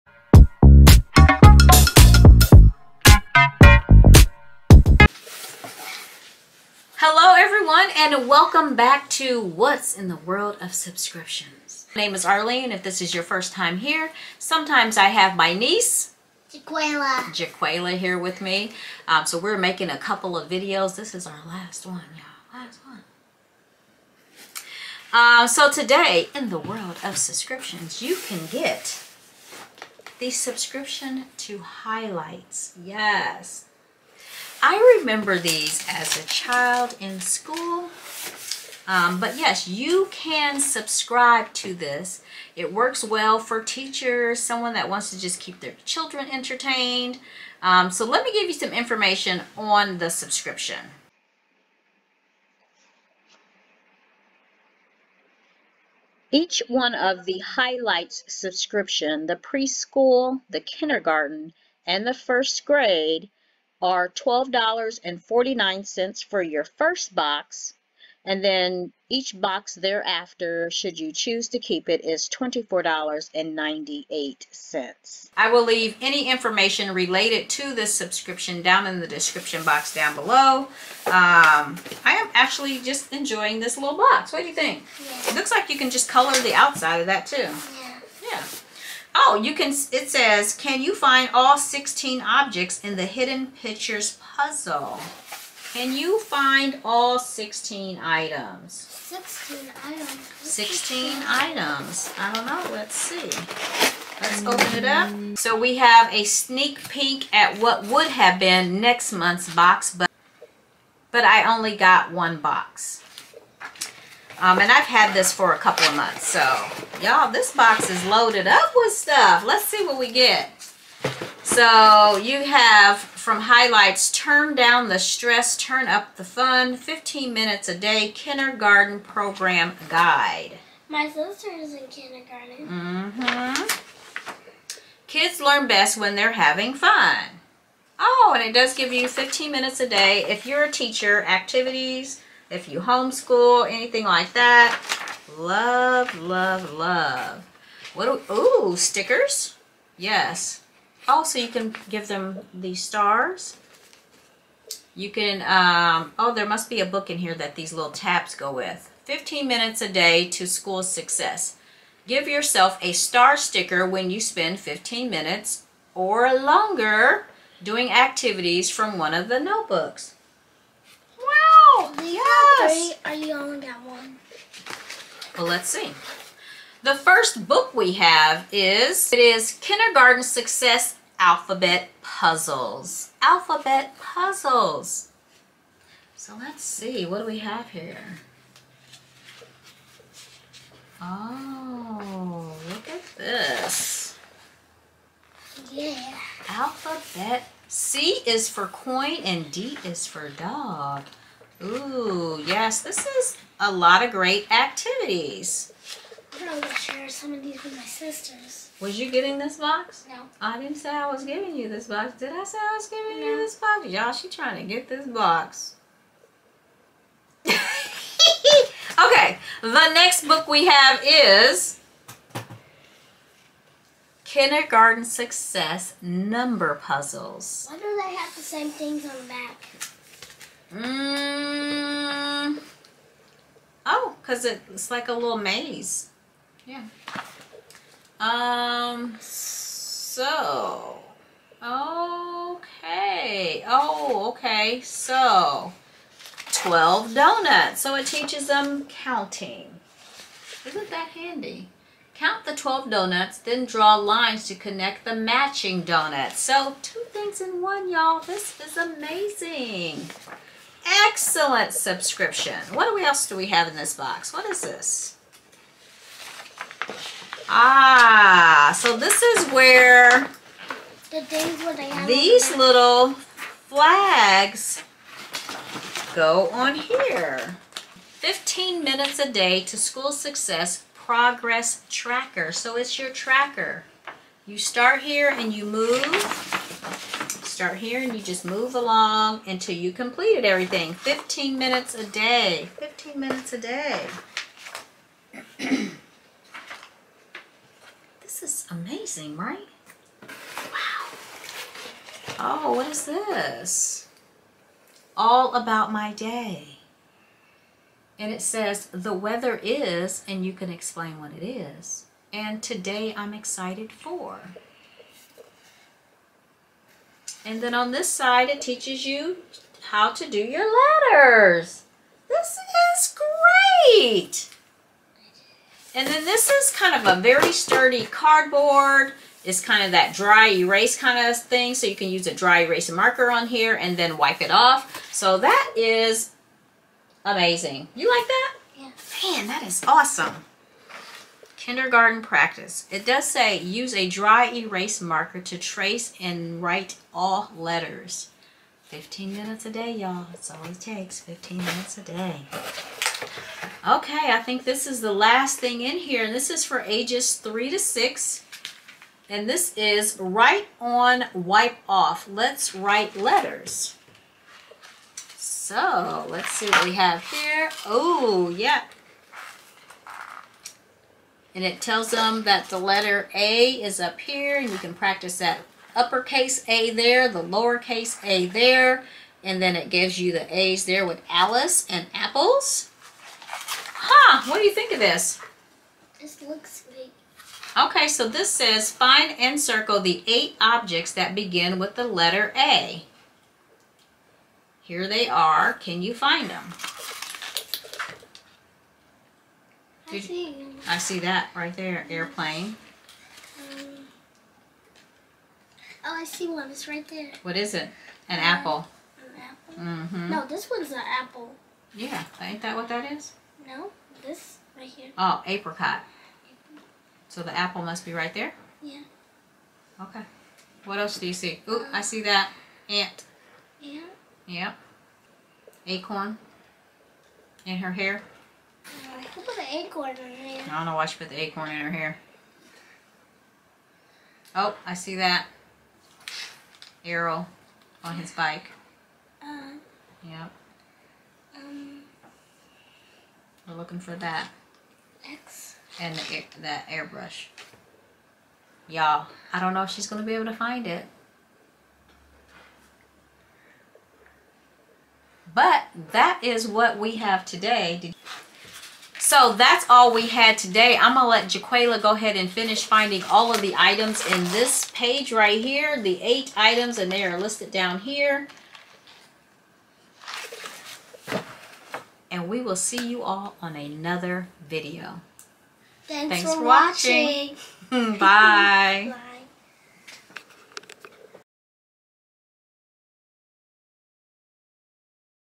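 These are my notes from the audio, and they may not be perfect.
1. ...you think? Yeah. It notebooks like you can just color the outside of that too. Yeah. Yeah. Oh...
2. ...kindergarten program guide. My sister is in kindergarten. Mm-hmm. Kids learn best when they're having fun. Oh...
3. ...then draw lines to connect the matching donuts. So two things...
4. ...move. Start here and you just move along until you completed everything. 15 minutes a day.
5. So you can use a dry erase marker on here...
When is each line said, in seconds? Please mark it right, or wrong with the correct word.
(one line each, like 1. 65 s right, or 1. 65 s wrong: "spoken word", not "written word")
1. 84 s wrong: "looks", not "notebooks"
2. 128 s right
3. 253 s right
4. 285 s right
5. 331 s right.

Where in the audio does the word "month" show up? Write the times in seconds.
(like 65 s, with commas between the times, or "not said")
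109 s, 115 s.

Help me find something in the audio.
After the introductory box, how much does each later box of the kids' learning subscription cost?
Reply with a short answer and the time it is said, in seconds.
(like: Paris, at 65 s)
$24.98, at 72 s.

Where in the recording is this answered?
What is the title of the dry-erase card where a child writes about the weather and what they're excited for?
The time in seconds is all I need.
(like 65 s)
305 s.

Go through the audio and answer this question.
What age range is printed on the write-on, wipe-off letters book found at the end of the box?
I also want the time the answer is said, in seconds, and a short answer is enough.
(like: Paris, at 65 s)
3 to 6, at 356 s.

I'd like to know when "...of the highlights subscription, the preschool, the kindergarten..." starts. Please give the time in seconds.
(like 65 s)
56 s.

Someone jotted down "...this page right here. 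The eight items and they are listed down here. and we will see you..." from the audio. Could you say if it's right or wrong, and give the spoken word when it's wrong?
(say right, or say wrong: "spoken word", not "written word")
right.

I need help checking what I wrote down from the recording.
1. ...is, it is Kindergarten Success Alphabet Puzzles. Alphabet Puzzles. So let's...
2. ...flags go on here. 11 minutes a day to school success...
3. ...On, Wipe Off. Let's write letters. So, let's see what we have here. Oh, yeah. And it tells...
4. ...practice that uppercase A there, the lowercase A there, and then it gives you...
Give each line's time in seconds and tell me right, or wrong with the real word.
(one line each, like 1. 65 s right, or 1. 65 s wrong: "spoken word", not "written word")
1. 178 s right
2. 273 s wrong: "15", not "11"
3. 360 s right
4. 374 s right.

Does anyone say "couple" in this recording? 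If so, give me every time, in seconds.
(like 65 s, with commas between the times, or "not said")
19 s, 115 s.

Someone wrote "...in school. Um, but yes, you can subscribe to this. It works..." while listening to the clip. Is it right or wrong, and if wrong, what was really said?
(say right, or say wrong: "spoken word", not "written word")
right.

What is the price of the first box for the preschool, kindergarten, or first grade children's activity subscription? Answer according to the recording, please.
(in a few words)
$12.49.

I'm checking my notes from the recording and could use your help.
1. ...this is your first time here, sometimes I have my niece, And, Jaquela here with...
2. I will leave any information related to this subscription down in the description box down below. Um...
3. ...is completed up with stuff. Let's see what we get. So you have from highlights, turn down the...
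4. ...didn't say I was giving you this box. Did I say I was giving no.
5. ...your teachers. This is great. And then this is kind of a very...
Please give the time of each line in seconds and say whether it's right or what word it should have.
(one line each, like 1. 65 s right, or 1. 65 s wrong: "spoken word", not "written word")
1. 12 s wrong: "Jaquela", not "And"
2. 75 s right
3. 117 s wrong: "loaded", not "completed"
4. 210 s right
5. 320 s wrong: "letters", not "teachers".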